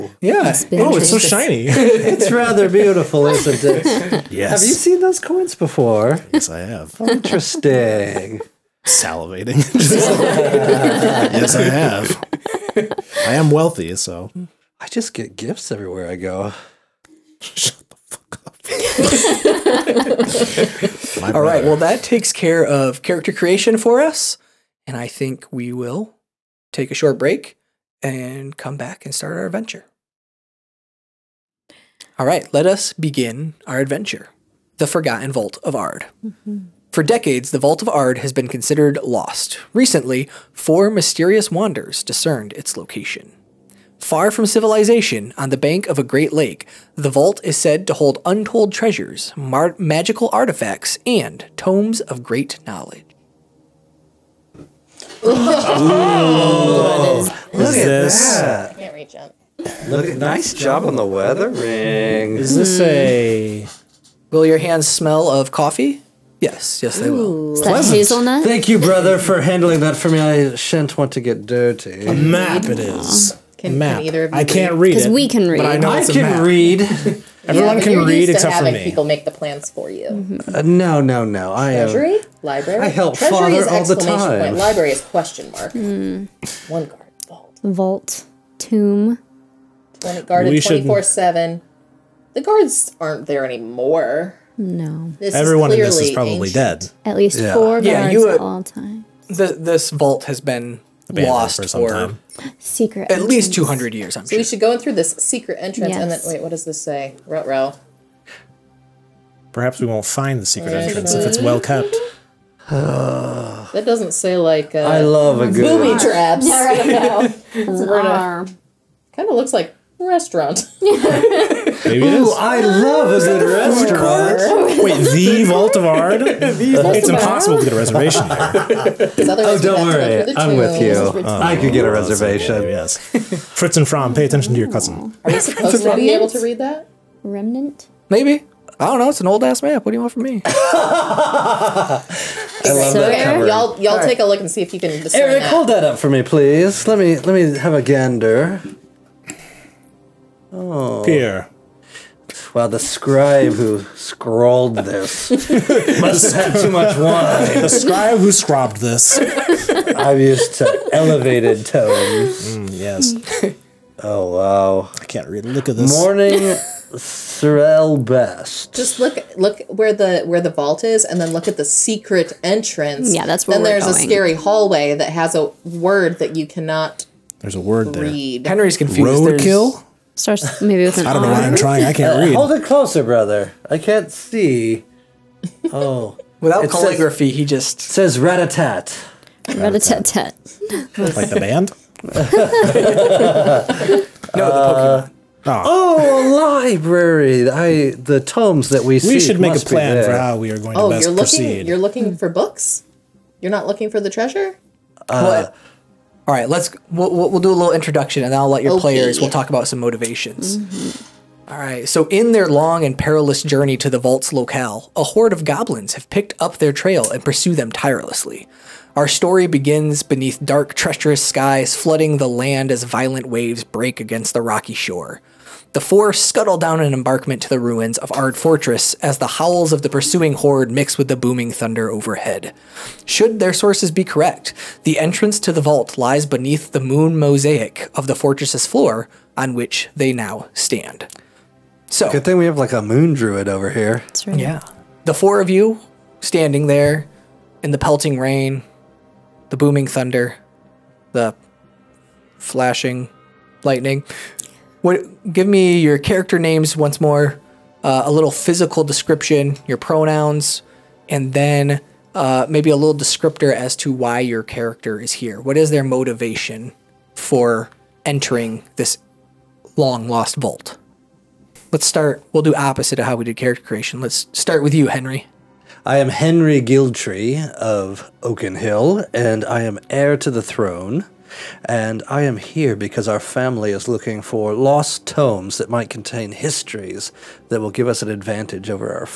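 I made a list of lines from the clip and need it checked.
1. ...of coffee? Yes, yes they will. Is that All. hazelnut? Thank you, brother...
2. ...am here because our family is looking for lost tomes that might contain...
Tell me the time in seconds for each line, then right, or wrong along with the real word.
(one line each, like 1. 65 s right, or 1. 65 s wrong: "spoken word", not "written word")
1. 65 s wrong: "Pleasant", not "All"
2. 282 s right.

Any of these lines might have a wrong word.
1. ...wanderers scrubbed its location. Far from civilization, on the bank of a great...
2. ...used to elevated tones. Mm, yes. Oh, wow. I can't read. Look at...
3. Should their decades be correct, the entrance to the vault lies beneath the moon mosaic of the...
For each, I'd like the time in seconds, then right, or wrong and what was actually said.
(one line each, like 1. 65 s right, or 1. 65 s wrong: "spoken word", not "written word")
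1. 41 s wrong: "discerned", not "scrubbed"
2. 160 s right
3. 233 s wrong: "sources", not "decades".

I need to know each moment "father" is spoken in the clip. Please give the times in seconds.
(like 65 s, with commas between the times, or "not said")
83 s.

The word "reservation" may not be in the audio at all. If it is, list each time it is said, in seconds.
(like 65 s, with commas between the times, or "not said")
127 s, 131 s.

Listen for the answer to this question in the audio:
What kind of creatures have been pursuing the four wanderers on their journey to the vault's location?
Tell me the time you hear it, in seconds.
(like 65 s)
215 s.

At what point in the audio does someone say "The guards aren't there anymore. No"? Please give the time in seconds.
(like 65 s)
92 s.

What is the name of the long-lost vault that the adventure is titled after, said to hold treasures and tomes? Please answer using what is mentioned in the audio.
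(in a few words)
The Forgotten Vault of Ard.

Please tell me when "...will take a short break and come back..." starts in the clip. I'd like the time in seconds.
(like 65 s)
25 s.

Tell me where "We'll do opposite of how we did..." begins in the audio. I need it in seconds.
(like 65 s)
272 s.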